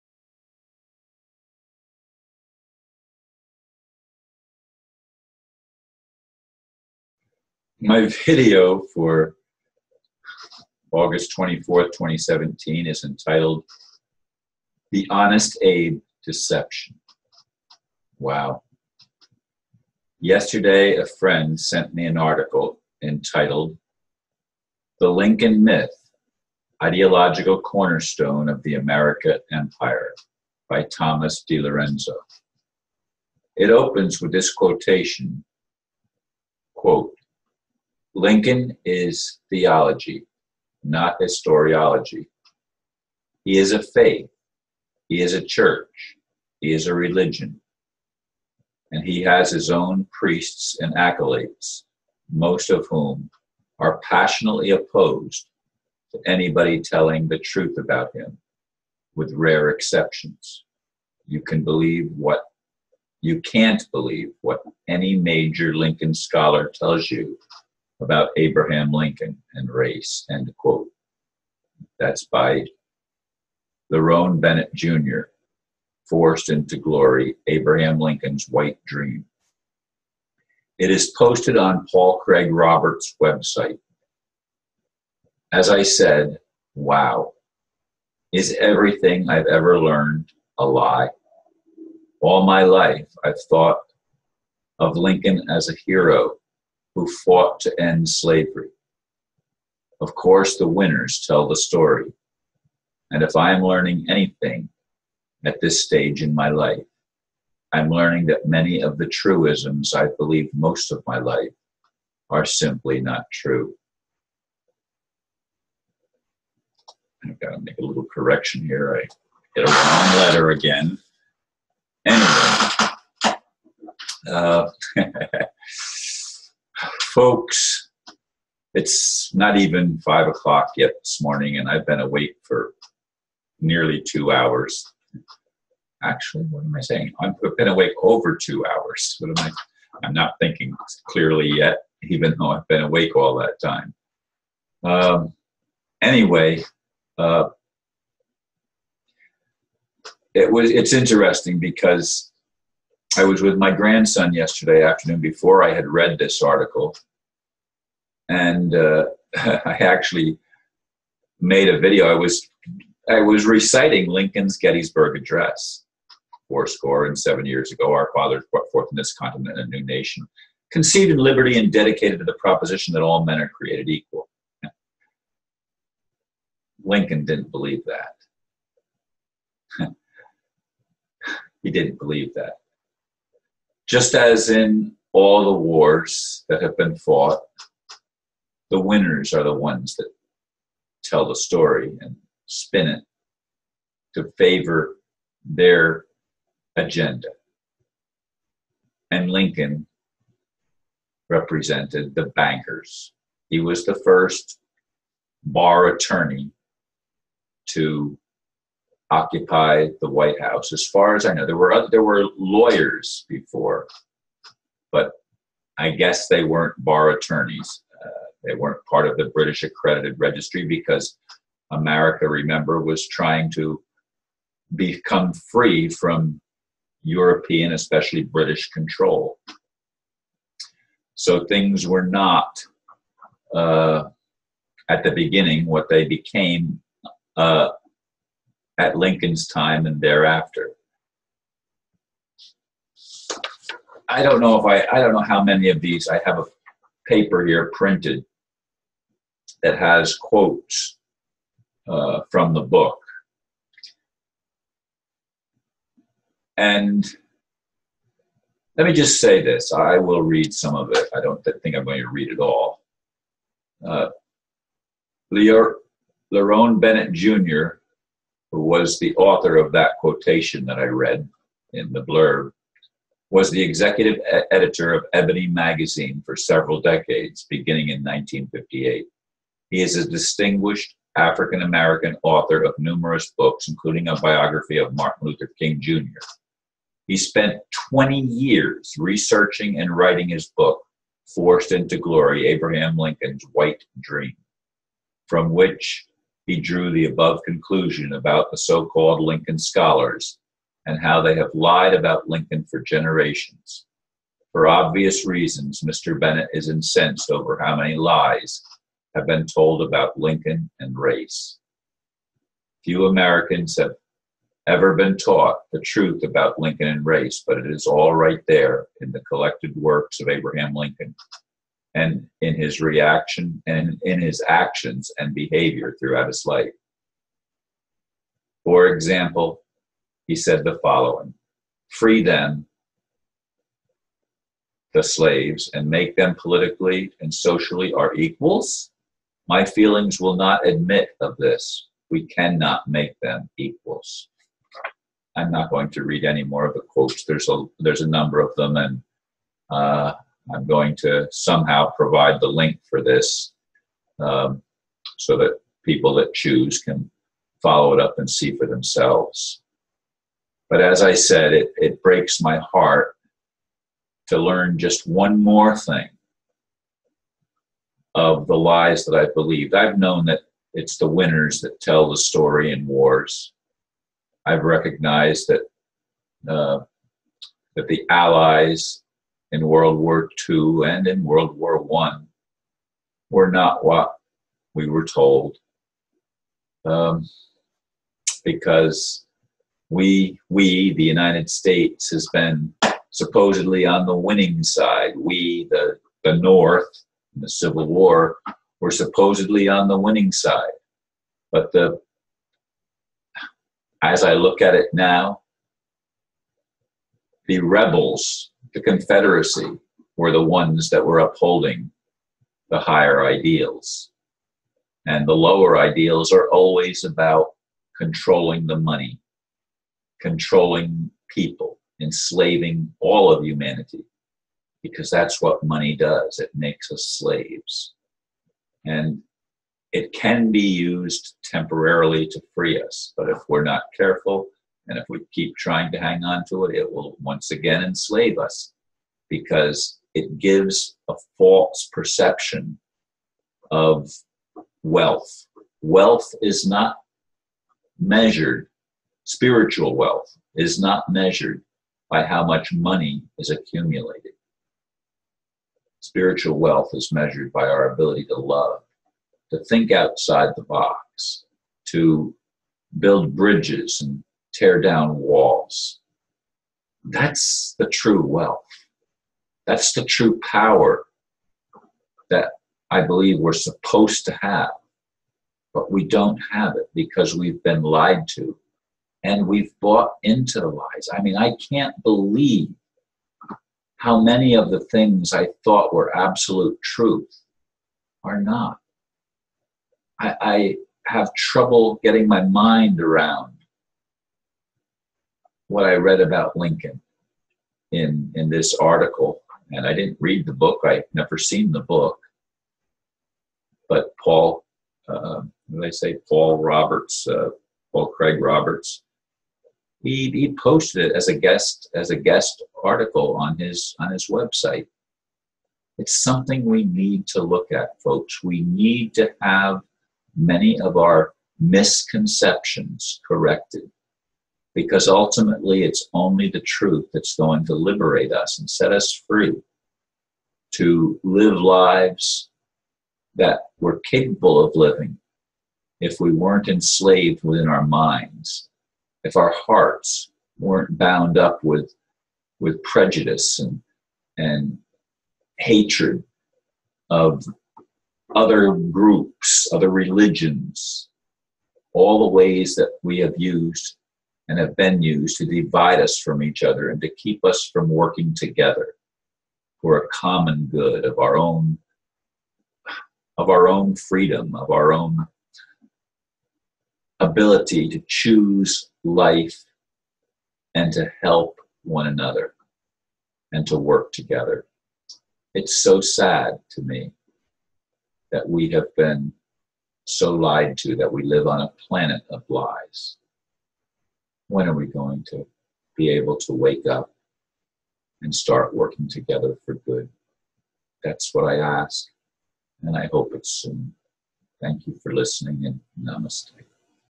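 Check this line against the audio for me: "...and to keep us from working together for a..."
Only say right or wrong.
right.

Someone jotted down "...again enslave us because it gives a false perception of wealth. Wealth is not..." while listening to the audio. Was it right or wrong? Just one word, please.
right.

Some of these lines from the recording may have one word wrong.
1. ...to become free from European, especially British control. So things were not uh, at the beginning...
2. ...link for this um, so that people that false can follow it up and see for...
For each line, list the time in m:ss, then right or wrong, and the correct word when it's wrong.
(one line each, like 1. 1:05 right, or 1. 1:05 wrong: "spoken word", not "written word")
1. 3:43 right
2. 5:52 wrong: "choose", not "false".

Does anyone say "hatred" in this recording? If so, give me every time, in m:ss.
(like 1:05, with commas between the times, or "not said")
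9:05.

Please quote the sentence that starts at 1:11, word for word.
That's by Lerone Bennett Jr., Forced into Glory, Abraham Lincoln's White Dream.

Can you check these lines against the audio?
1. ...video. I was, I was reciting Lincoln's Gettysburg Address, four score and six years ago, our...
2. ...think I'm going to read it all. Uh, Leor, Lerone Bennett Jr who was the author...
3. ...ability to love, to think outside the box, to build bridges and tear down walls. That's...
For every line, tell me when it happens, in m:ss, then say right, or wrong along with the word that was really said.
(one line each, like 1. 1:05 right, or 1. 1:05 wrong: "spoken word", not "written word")
1. 2:41 wrong: "seven", not "six"
2. 4:21 right
3. 7:37 right.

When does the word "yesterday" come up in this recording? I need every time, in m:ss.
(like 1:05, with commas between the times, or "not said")
0:20, 2:34.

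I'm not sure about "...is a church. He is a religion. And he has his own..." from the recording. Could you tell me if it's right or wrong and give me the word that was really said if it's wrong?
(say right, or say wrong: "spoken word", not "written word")
right.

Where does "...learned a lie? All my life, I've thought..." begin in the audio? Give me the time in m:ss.
1:29.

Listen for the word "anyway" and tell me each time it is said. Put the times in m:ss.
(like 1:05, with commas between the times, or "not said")
2:02, 2:26.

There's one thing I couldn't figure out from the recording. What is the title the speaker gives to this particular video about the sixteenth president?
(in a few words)
The Honest Abe Deception.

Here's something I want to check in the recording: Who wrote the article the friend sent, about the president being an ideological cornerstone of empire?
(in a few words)
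Thomas DiLorenzo.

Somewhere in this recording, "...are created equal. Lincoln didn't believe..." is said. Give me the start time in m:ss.
2:53.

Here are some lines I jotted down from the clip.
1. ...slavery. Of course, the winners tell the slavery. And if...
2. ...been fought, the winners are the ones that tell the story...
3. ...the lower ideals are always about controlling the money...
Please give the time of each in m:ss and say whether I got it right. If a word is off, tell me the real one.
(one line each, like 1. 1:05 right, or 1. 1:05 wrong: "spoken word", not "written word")
1. 1:38 wrong: "story", not "slavery"
2. 3:06 right
3. 6:55 right.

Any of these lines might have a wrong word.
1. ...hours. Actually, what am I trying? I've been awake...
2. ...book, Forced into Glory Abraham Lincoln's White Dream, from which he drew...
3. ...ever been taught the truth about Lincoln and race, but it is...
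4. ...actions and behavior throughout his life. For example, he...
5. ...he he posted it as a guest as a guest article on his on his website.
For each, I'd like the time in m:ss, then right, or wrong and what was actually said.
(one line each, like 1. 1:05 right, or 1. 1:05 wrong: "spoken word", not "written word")
1. 2:14 wrong: "saying", not "trying"
2. 4:50 right
3. 5:14 right
4. 5:24 right
5. 8:30 right.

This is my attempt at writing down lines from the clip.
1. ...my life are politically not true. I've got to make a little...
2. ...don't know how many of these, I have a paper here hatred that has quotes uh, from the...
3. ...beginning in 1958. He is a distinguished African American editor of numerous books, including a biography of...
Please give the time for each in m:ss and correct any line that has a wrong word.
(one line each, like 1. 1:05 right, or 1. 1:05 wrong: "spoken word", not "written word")
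1. 1:51 wrong: "simply", not "politically"
2. 4:04 wrong: "printed", not "hatred"
3. 4:37 wrong: "author", not "editor".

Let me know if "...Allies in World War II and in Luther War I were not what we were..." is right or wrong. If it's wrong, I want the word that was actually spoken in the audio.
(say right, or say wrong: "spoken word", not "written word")
wrong: "World", not "Luther".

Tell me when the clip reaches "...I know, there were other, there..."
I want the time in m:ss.
3:31.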